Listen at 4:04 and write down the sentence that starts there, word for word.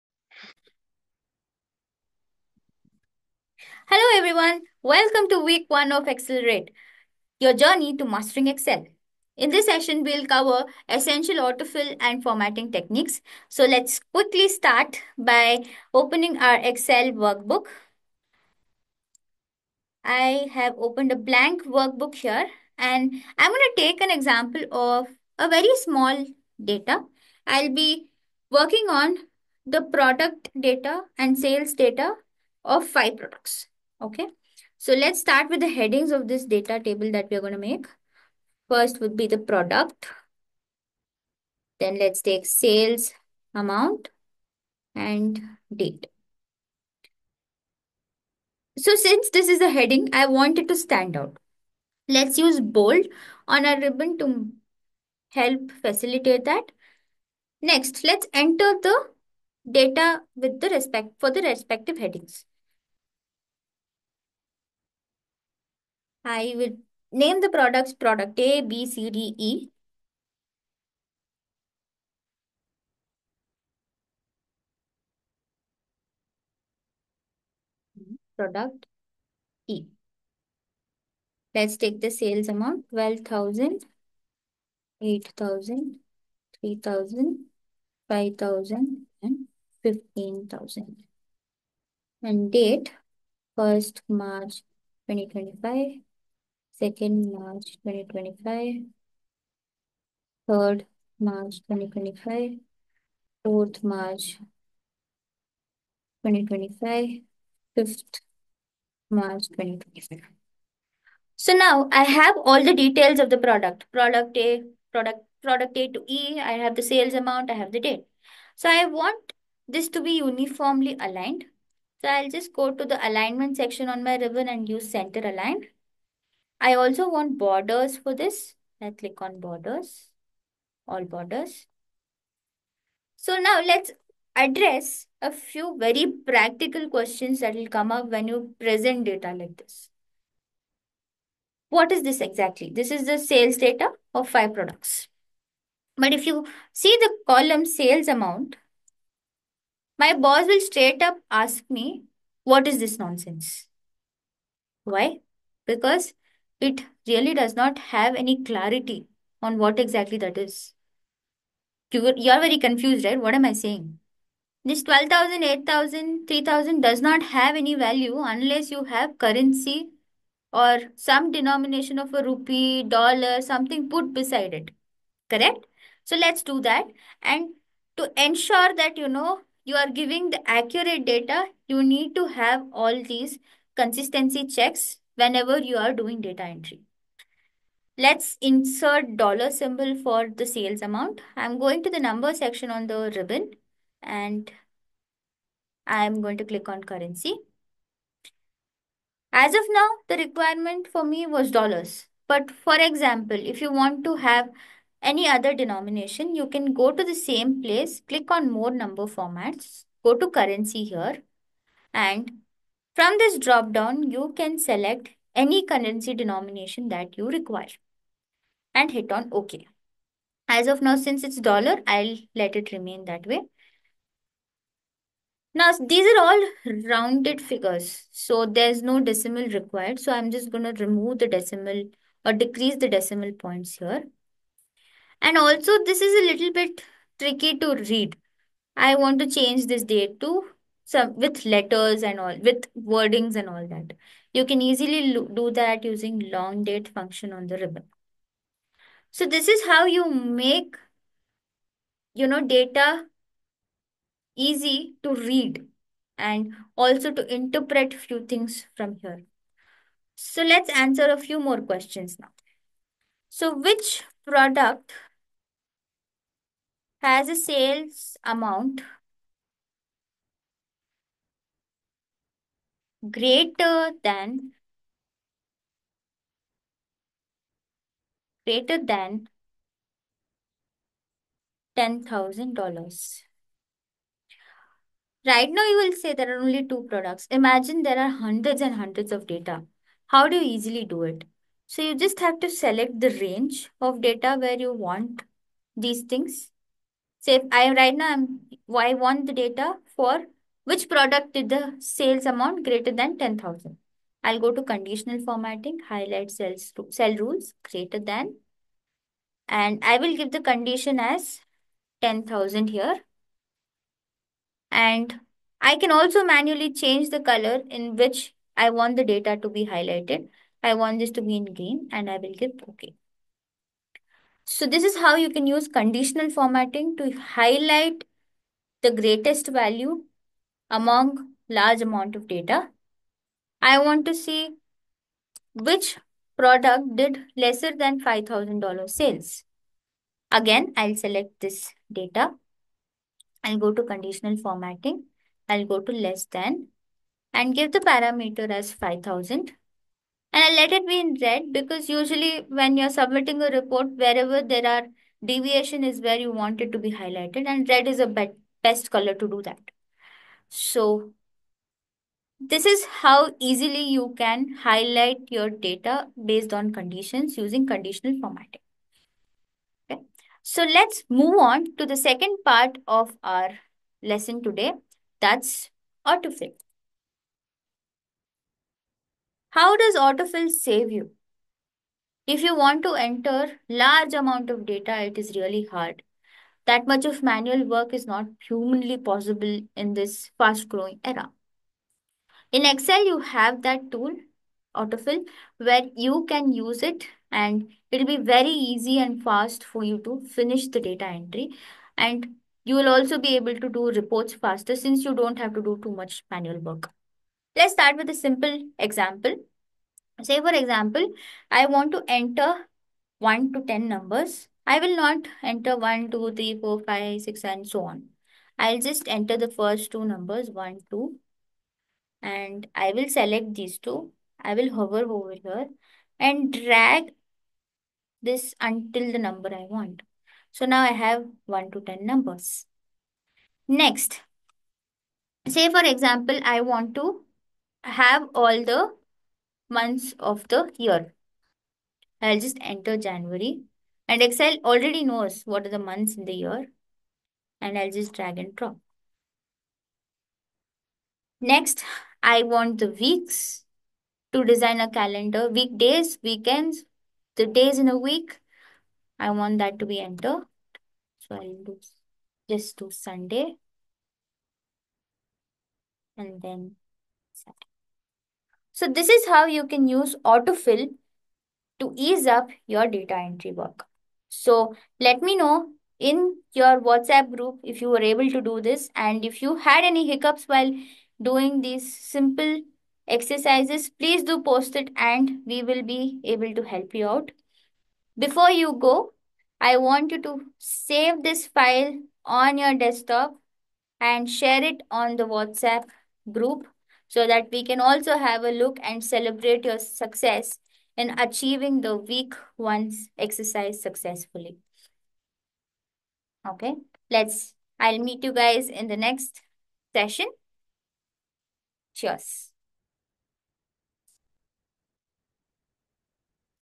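You can easily do that using long date function on the ribbon.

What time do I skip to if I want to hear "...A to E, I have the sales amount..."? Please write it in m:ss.
1:55.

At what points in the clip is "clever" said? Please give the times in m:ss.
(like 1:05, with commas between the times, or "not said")
not said.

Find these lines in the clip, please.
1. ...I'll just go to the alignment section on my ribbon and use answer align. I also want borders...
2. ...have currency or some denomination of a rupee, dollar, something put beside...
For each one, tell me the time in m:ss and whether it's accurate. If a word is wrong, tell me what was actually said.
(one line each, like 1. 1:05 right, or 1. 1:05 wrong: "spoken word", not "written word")
1. 2:02 wrong: "center", not "answer"
2. 2:48 right.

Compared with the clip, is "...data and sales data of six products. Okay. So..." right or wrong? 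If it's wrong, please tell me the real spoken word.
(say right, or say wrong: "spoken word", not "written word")
wrong: "five", not "six".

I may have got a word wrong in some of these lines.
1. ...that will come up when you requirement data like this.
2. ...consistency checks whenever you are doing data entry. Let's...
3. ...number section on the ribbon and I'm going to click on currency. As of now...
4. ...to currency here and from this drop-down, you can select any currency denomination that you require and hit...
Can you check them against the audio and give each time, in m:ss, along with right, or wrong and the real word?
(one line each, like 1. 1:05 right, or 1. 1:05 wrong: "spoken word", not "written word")
1. 2:17 wrong: "present", not "requirement"
2. 3:03 right
3. 3:11 right
4. 3:30 right.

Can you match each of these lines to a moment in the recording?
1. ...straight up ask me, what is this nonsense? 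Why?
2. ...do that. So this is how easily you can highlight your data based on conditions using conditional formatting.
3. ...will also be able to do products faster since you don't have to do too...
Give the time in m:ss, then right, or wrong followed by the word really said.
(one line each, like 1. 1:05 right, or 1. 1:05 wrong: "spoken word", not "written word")
1. 2:30 right
2. 5:59 right
3. 6:42 wrong: "reports", not "products".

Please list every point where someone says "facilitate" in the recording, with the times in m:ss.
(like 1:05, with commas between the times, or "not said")
0:55.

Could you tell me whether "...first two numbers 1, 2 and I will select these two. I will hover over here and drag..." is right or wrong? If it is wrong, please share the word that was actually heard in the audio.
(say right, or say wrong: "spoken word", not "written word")
right.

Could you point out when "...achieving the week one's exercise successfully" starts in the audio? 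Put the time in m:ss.
8:21.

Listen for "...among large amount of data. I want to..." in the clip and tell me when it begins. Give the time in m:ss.
5:30.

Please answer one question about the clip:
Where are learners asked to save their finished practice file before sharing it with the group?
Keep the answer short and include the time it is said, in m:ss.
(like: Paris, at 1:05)
Desktop, at 8:12.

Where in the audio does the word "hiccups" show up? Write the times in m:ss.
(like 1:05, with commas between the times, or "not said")
8:00.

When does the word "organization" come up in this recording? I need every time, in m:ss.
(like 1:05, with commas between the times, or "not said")
not said.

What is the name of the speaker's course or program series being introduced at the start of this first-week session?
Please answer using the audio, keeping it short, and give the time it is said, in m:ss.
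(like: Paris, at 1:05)
Excelerate, at 0:06.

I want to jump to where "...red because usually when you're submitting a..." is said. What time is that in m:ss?
5:51.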